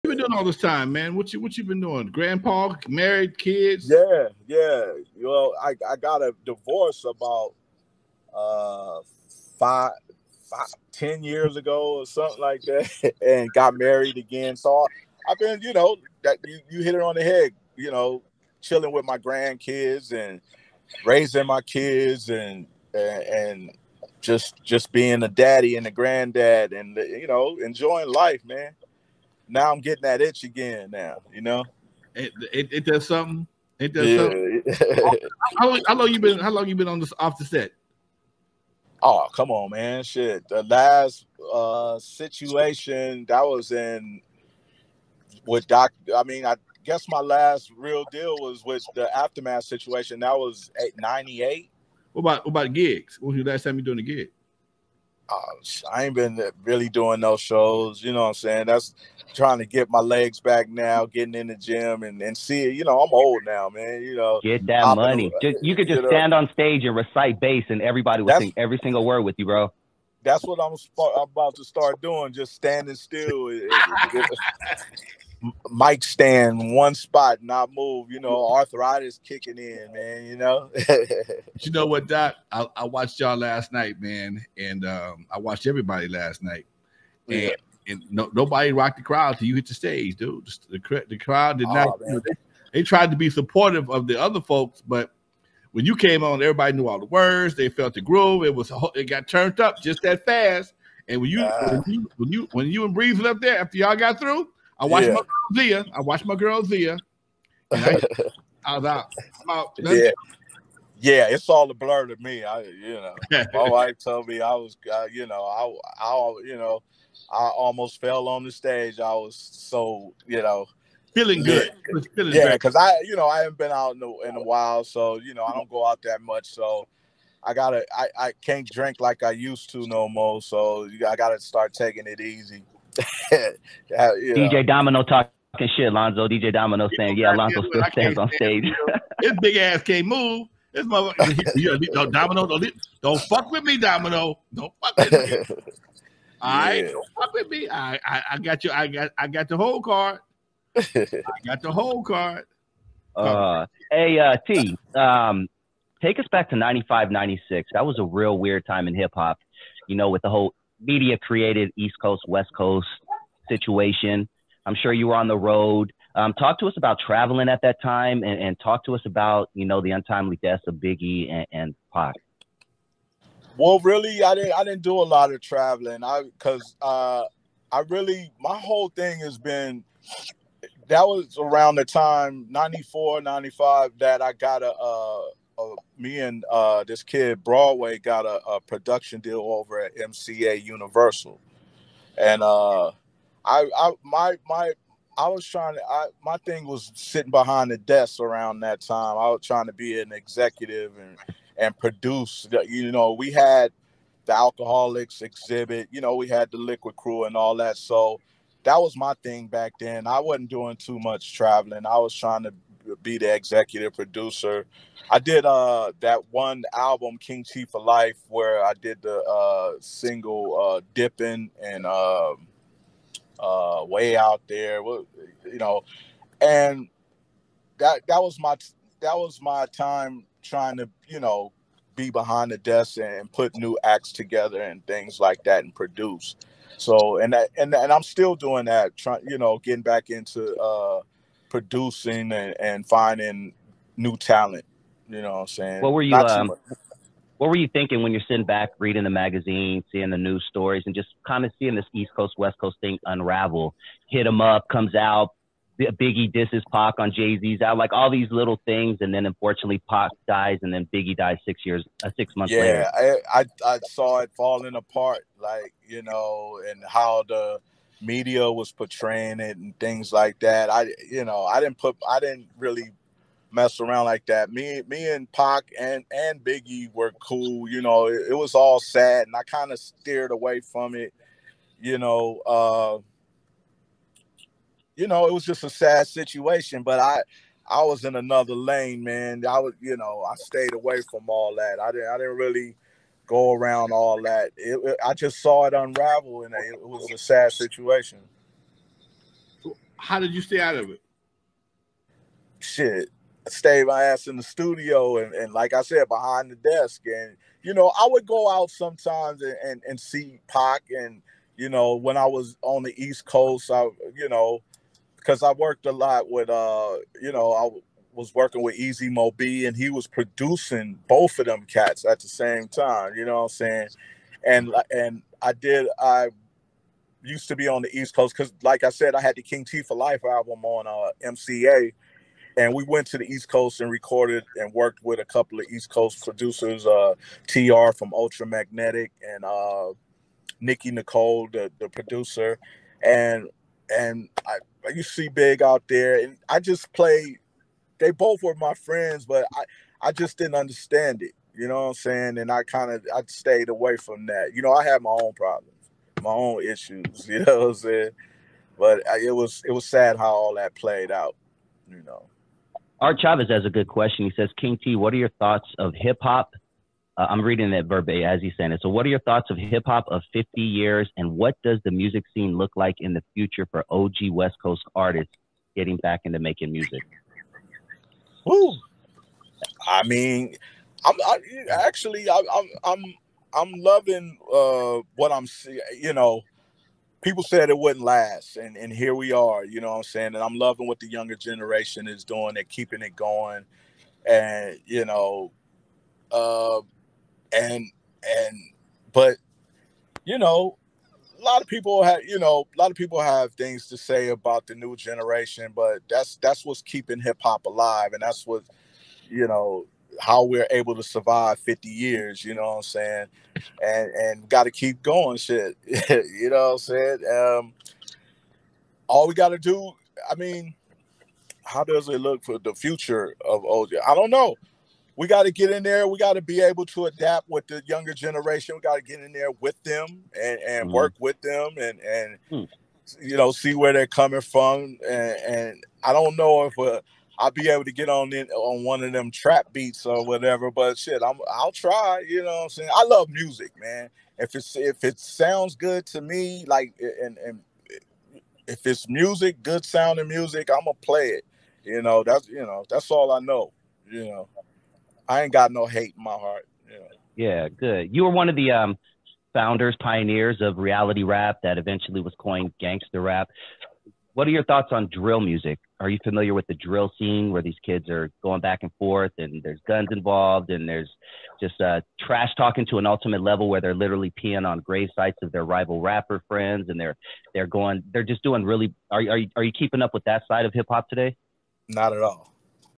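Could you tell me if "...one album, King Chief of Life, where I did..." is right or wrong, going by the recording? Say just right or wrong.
right.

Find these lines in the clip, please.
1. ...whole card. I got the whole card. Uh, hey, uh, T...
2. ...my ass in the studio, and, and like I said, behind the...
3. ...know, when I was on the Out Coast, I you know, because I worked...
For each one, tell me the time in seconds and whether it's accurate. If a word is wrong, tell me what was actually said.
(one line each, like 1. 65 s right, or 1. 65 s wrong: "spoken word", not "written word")
1. 149 s right
2. 303 s right
3. 311 s wrong: "East", not "Out".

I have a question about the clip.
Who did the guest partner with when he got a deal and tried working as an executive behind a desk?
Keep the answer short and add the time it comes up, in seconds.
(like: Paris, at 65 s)
Broadway, at 187 s.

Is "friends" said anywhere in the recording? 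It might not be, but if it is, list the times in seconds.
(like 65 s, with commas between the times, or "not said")
348 s, 476 s.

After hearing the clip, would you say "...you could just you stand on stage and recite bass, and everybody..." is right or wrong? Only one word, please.
right.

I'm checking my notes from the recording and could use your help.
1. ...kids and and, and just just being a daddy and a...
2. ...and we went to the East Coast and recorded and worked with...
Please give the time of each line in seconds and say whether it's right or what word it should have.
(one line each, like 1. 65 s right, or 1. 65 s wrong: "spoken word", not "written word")
1. 21 s right
2. 332 s right.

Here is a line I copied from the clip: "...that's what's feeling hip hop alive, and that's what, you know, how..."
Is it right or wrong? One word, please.
wrong.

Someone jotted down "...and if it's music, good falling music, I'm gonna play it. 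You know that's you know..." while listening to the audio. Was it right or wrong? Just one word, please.
wrong.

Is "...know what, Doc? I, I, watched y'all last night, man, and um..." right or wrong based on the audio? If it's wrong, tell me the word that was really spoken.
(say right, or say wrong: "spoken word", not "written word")
right.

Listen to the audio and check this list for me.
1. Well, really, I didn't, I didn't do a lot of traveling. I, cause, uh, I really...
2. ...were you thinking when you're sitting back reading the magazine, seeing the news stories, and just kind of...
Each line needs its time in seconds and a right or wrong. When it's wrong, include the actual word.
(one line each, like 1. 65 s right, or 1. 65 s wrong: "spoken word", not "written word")
1. 173 s right
2. 247 s right.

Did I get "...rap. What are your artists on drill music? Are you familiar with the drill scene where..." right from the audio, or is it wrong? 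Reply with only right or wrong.
wrong.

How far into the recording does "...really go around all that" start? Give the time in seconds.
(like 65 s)
292 s.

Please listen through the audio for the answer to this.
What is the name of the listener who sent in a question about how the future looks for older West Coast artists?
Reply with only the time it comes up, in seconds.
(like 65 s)
362 s.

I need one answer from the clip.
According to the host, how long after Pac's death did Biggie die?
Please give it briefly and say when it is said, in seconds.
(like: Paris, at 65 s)
6 months, at 262 s.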